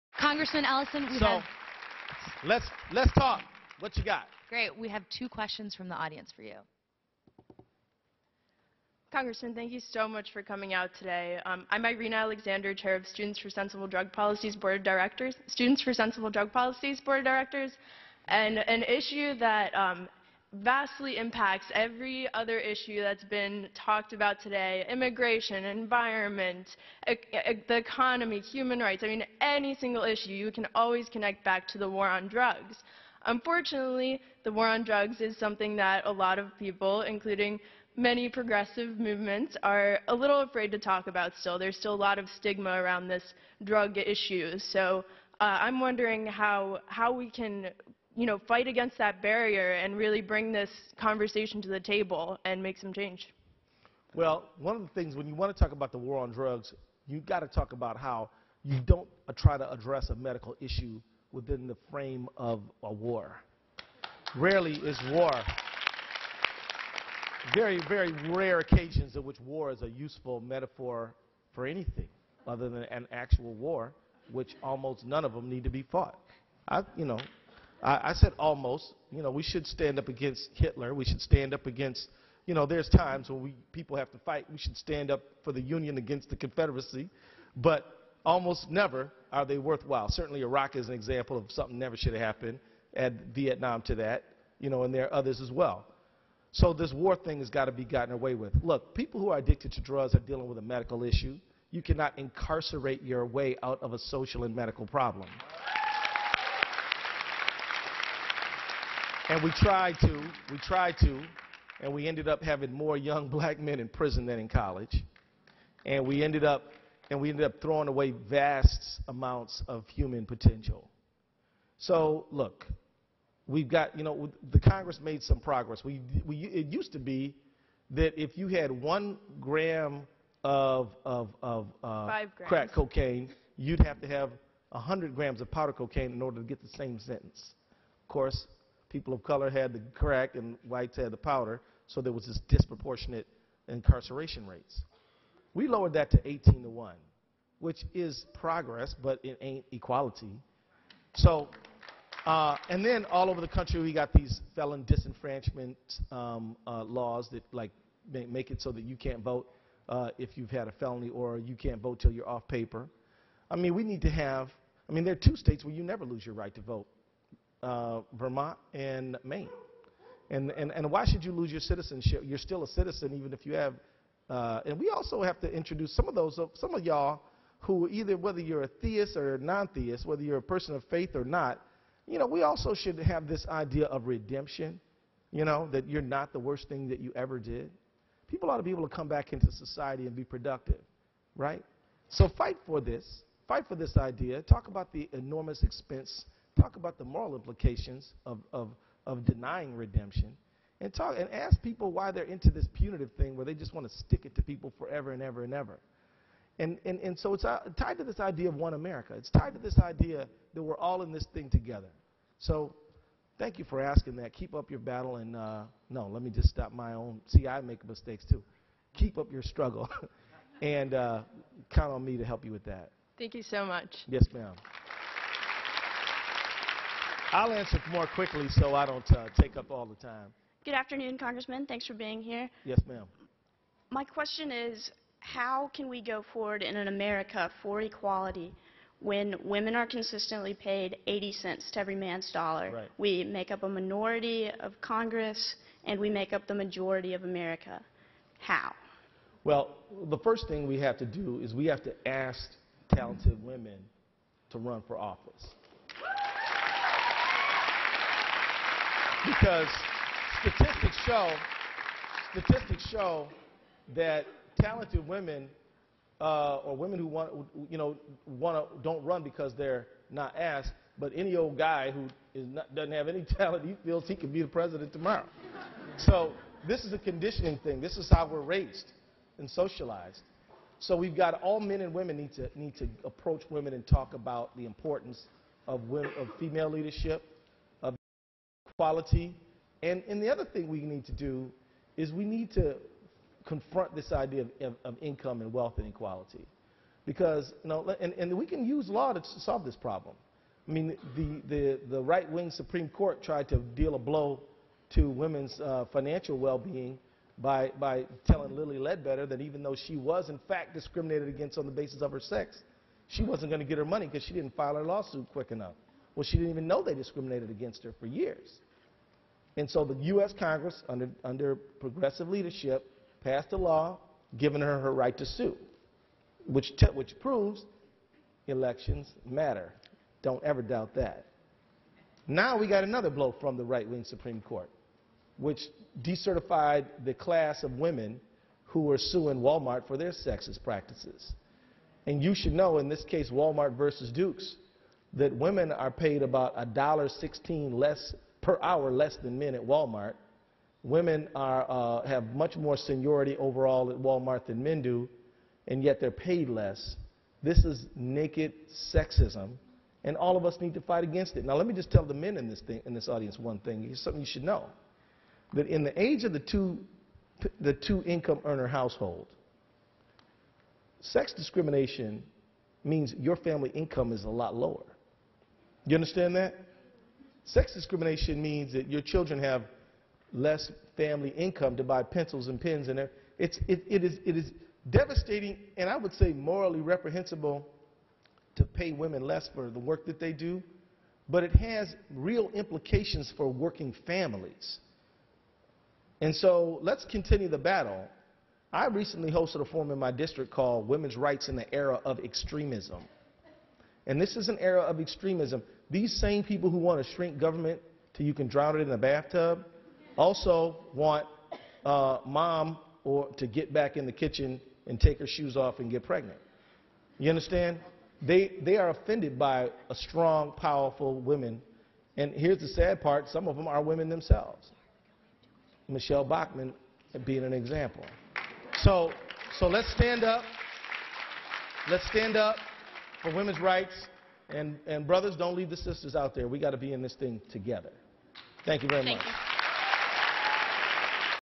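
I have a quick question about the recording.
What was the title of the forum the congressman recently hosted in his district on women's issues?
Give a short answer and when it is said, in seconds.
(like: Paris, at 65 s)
Women's Rights in the Era of Extremism, at 400 s.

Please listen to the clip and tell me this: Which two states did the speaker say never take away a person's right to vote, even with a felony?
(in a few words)
Vermont and Maine.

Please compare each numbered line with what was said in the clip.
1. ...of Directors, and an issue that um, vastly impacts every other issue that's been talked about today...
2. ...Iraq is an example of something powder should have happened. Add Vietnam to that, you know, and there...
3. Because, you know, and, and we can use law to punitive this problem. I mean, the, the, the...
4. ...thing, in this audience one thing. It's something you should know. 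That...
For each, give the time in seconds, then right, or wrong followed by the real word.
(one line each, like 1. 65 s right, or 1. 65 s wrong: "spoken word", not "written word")
1. 17 s right
2. 90 s wrong: "never", not "powder"
3. 297 s wrong: "solve", not "punitive"
4. 362 s right.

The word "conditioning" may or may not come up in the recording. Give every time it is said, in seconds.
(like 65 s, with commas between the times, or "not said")
276 s.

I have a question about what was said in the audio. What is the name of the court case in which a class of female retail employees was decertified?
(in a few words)
Walmart versus Dukes.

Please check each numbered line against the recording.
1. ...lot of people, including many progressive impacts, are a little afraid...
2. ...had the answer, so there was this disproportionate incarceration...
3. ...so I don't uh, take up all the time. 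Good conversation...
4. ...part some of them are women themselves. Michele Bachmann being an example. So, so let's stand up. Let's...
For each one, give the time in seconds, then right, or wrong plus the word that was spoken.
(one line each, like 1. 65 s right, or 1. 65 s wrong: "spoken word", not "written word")
1. 36 s wrong: "movements", not "impacts"
2. 140 s wrong: "powder", not "answer"
3. 228 s wrong: "afternoon", not "conversation"
4. 423 s right.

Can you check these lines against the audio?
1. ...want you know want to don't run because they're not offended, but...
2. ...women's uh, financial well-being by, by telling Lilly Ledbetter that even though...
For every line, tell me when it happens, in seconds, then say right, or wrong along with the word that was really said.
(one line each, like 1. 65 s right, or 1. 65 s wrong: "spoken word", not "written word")
1. 267 s wrong: "asked", not "offended"
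2. 305 s right.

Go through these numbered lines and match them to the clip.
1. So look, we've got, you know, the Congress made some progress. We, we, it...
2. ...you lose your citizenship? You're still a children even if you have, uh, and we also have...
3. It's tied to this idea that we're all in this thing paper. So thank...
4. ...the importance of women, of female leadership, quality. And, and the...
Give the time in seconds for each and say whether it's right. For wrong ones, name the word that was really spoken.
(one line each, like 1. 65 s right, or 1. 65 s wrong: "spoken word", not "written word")
1. 121 s right
2. 171 s wrong: "citizen", not "children"
3. 209 s wrong: "together", not "paper"
4. 284 s right.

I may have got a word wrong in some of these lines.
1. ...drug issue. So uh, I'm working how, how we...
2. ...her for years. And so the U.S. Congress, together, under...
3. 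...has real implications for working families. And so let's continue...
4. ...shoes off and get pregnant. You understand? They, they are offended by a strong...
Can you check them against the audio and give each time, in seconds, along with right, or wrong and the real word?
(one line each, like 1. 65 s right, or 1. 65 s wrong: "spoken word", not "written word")
1. 43 s wrong: "wondering", not "working"
2. 317 s wrong: "under", not "together"
3. 391 s right
4. 415 s right.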